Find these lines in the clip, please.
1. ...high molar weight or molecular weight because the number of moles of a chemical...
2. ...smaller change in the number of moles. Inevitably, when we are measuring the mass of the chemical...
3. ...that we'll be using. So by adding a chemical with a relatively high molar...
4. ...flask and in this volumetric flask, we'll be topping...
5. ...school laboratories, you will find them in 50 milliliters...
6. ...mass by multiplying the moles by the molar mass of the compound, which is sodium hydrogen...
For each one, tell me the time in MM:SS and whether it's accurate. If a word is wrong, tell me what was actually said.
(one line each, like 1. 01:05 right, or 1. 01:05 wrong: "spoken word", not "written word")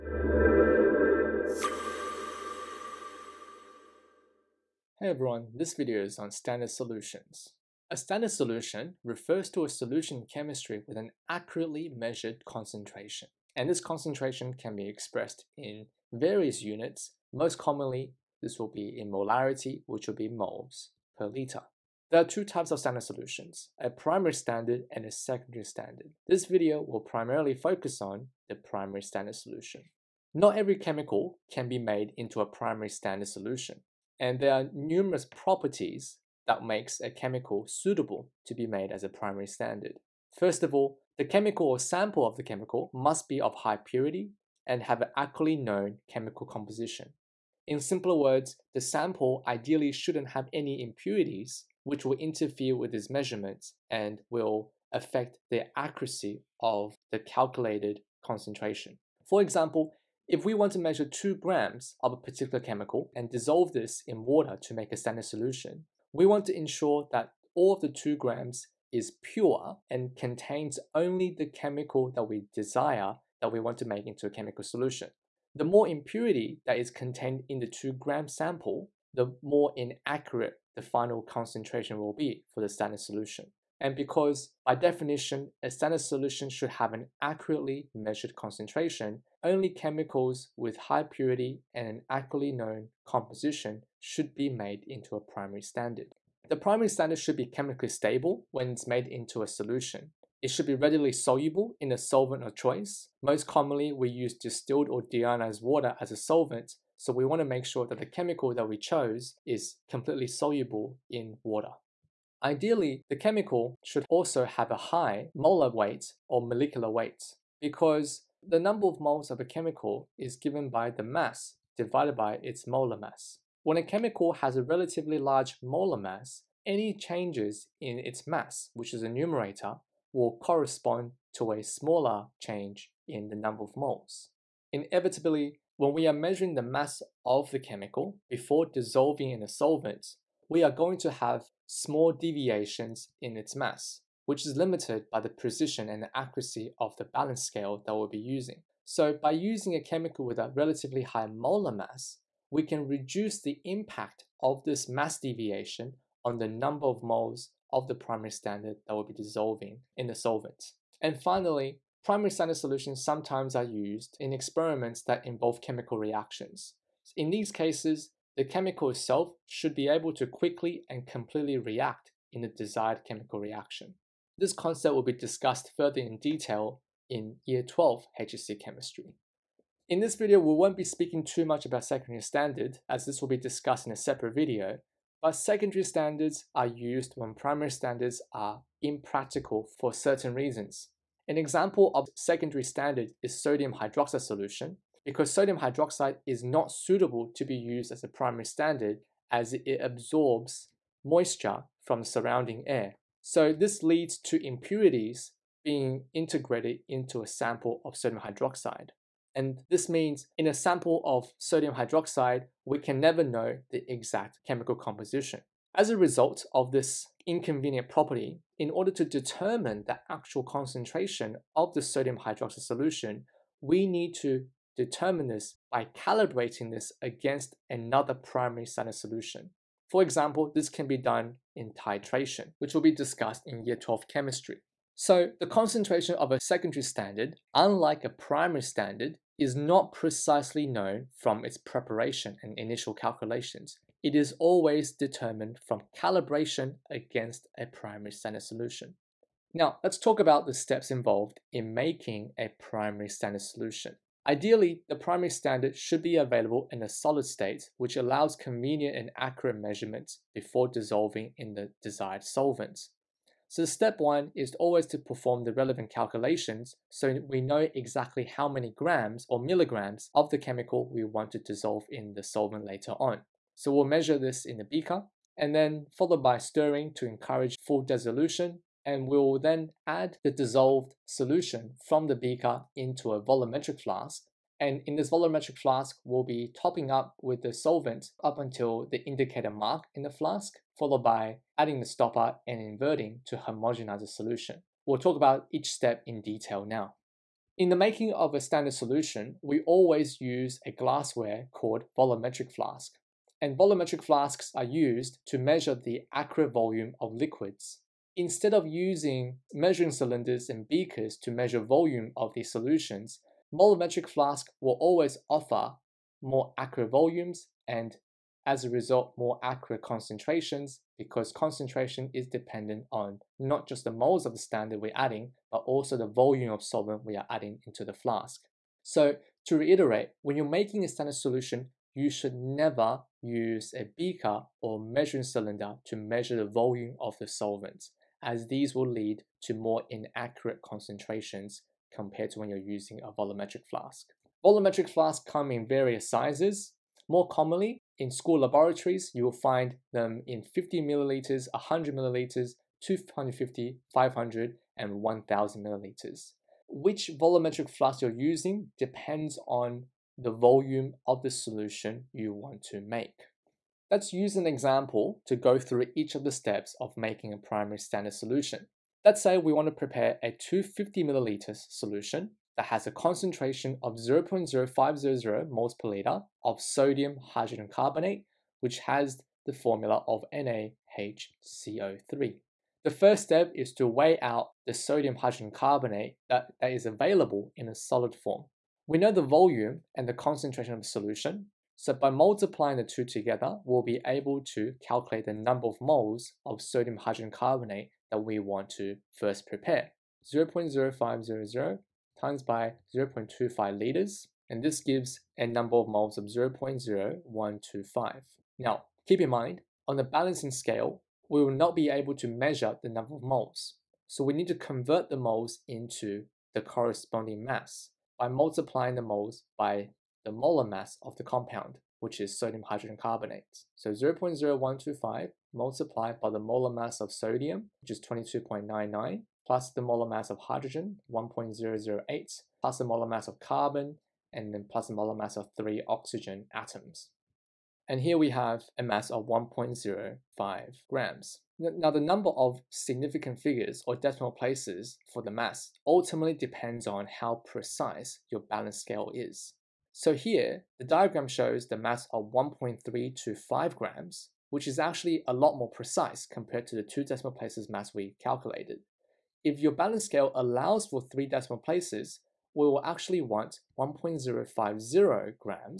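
1. 01:54 right
2. 02:11 right
3. 02:27 wrong: "using", not "adding"
4. 04:43 right
5. 05:48 right
6. 06:57 right.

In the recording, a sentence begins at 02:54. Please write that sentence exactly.
This concept will be discussed further in detail in Year 12 HSC Chemistry.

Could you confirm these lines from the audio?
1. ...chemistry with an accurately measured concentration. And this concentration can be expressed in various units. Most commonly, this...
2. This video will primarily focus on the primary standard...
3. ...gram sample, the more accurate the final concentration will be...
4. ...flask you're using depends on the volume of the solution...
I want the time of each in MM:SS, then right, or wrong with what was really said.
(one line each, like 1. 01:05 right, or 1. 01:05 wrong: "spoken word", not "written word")
1. 00:10 right
2. 00:26 right
3. 01:17 wrong: "inaccurate", not "accurate"
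4. 05:57 right.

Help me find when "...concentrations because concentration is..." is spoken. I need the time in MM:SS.
05:19.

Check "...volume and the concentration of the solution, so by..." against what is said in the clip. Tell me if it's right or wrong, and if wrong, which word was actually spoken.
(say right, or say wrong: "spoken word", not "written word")
right.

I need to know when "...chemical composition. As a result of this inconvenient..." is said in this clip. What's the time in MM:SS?
03:34.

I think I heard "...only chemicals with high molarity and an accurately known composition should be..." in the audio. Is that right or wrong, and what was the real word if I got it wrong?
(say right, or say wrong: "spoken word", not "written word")
wrong: "purity", not "molarity".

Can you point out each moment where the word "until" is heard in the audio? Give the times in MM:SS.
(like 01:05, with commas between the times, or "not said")
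04:48.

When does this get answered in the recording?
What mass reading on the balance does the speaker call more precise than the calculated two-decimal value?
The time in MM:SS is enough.
07:32.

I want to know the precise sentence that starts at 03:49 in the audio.
For example, this can be done in titration, which will be discussed in year 12 chemistry.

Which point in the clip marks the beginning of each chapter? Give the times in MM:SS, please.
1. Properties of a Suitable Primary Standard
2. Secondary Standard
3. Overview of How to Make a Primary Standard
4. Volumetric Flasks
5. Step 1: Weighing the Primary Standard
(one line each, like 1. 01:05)
1. 00:29
2. 02:58
3. 04:09
4. 04:57
5. 06:04.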